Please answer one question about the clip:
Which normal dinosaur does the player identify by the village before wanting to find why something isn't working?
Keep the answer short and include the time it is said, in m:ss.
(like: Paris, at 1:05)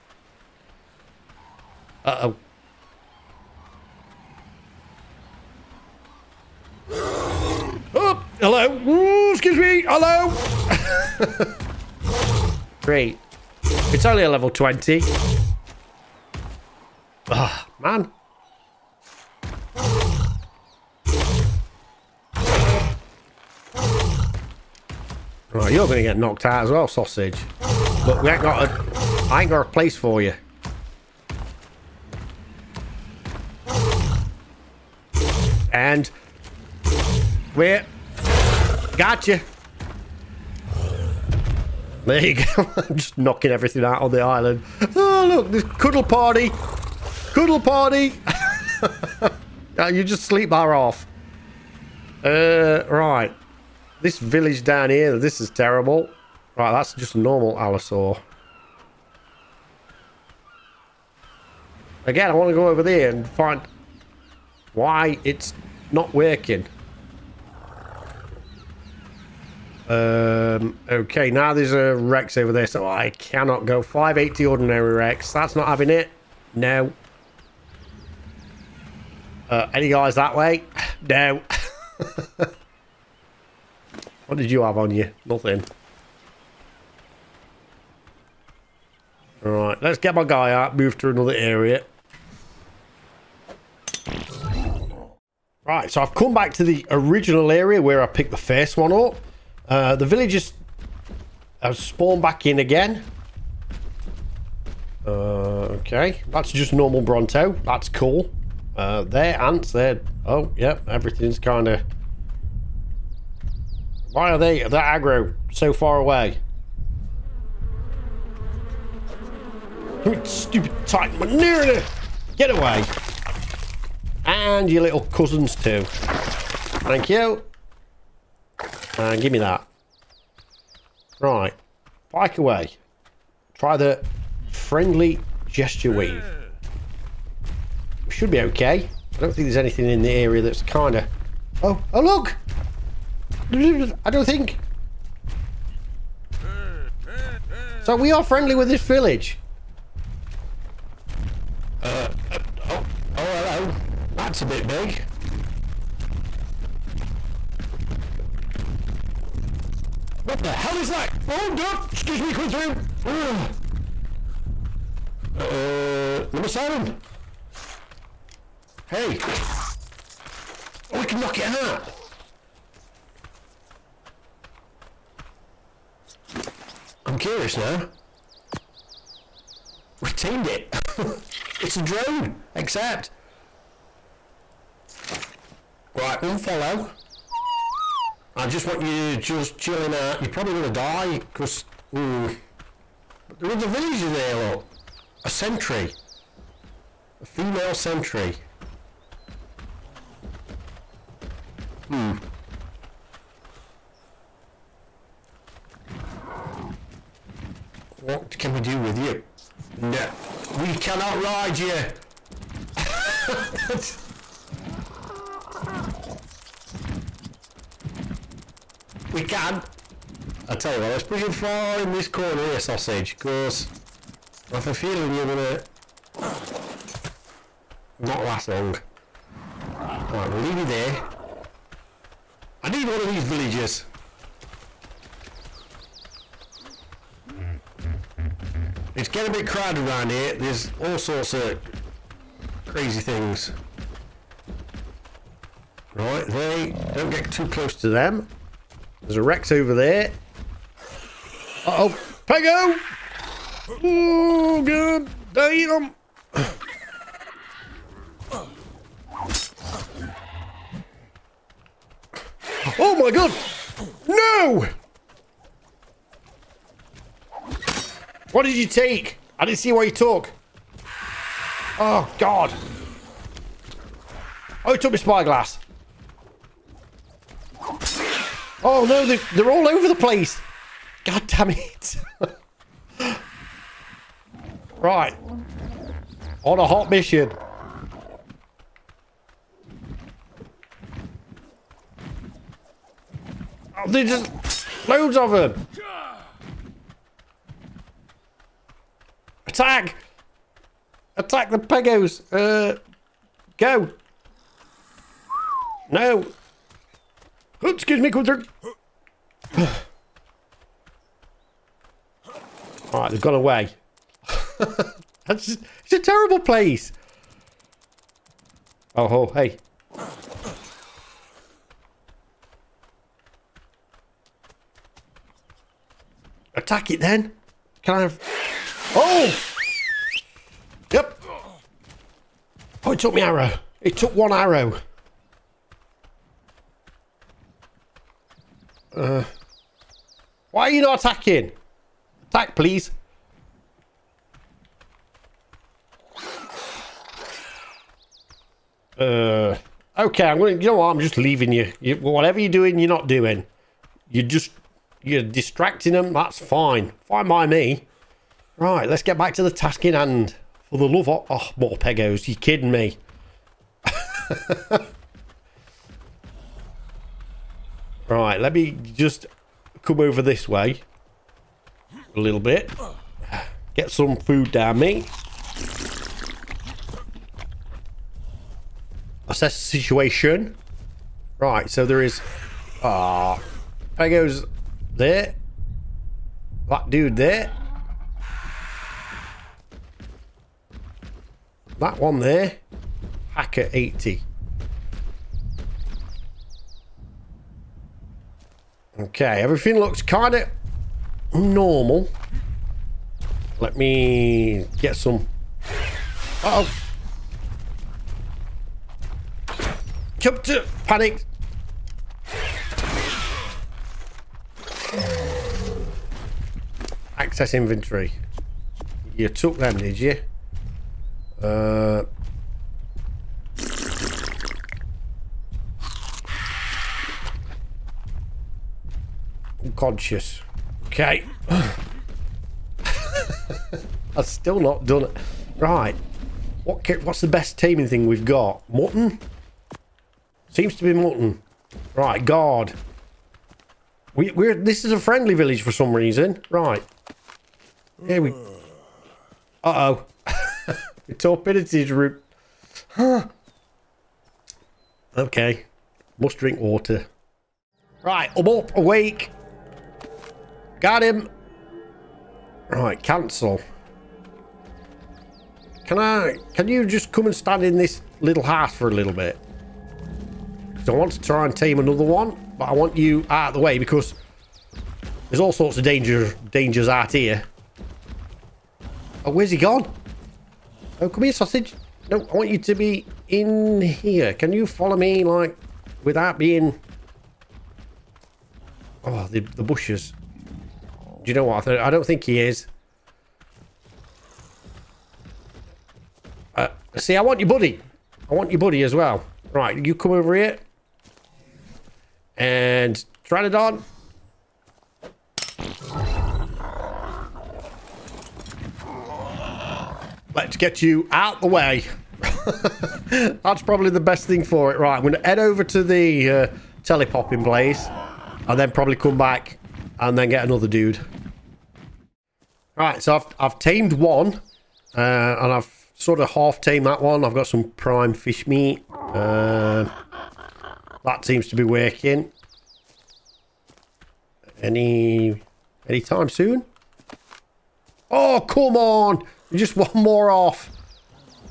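Allosaur, at 0:57.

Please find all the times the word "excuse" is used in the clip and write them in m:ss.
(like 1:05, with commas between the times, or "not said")
0:09, 2:41, 5:07.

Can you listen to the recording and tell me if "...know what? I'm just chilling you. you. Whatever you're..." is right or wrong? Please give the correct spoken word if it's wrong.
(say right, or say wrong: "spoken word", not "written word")
wrong: "leaving", not "chilling".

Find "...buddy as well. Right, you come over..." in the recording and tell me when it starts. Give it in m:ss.
8:18.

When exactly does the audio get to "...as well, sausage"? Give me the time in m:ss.
0:26.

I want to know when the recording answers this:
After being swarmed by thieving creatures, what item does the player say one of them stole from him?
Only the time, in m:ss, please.
4:34.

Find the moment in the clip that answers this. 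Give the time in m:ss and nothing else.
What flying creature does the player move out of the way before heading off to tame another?
8:23.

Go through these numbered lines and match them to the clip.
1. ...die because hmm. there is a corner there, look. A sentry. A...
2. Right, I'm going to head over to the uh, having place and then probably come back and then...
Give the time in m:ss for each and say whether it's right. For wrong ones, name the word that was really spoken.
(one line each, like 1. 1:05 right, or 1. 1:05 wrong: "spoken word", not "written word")
1. 3:10 wrong: "villager", not "corner"
2. 8:34 wrong: "telepopping", not "having".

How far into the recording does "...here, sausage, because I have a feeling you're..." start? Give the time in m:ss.
3:42.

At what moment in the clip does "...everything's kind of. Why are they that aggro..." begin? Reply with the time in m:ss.
1:50.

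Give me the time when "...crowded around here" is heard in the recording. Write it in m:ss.
3:59.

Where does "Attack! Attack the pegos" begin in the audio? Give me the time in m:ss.
4:59.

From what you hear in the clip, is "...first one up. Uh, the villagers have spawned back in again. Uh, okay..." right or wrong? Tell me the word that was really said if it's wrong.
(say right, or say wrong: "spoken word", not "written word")
right.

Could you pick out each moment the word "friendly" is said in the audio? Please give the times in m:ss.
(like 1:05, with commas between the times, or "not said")
2:14, 2:28, 7:24.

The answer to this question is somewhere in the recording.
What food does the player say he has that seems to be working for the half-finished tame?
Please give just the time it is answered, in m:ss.
8:47.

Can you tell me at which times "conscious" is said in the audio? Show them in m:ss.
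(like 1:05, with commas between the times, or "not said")
7:09.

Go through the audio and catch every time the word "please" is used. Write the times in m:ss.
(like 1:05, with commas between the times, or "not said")
5:42.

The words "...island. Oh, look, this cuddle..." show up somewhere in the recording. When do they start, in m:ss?
0:44.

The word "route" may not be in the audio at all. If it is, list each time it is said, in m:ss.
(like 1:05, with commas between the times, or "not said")
not said.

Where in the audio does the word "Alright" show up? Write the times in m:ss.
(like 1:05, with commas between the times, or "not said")
1:29, 5:12.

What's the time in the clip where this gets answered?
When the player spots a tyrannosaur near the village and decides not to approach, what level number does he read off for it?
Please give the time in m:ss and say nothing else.
1:13.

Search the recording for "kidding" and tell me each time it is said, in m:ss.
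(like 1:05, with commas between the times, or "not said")
6:02.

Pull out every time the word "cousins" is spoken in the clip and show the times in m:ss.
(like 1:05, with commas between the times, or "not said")
2:05.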